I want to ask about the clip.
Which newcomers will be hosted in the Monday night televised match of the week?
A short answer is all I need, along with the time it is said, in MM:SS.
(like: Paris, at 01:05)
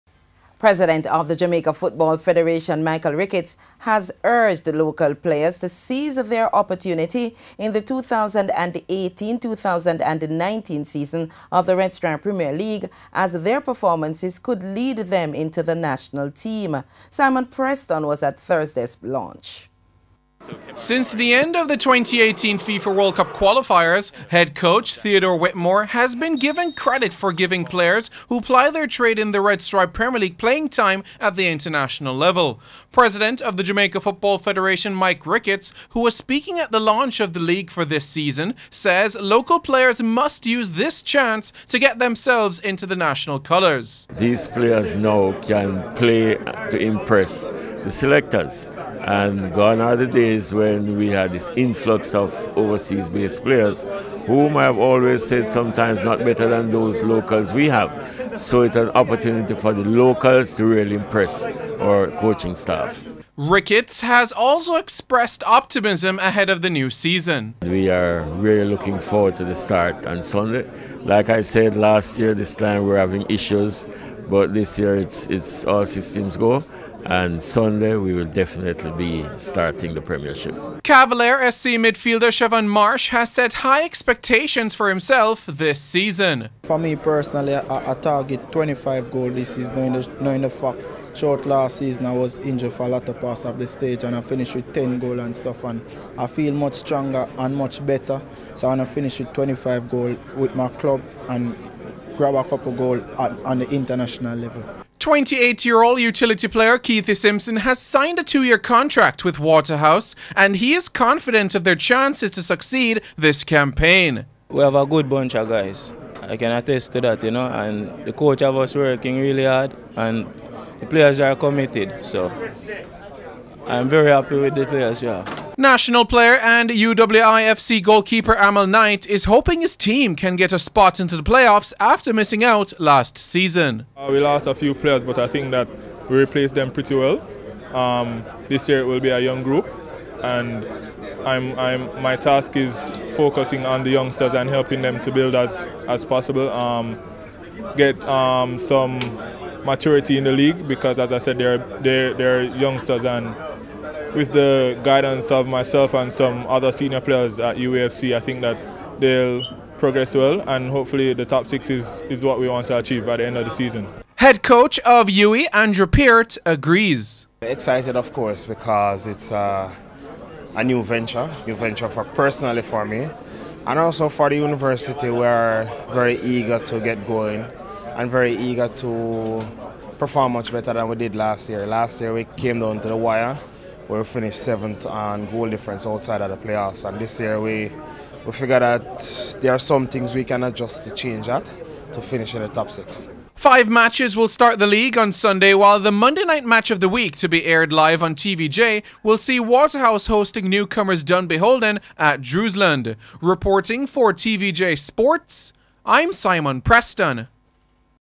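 Dunbeholden, at 03:21.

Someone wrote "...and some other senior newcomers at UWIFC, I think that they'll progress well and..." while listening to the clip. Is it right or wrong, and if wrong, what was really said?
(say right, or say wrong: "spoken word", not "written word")
wrong: "players", not "newcomers".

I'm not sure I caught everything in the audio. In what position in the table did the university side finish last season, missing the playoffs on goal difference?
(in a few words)
Seventh.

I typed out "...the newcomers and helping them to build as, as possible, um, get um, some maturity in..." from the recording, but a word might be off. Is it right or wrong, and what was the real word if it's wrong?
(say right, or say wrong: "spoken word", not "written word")
wrong: "youngsters", not "newcomers".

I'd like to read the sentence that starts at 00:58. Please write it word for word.
So it's an opportunity for the locals to really impress our coaching staff.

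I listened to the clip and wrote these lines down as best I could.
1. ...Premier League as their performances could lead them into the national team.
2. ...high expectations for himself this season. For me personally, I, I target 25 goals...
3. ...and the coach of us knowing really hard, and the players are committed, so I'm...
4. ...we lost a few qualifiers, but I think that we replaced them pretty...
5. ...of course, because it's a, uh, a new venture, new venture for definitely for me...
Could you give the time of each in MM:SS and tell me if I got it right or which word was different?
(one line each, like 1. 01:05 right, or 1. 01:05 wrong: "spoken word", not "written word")
1. 00:12 right
2. 01:23 right
3. 01:57 wrong: "working", not "knowing"
4. 02:14 wrong: "players", not "qualifiers"
5. 02:47 wrong: "personally", not "definitely".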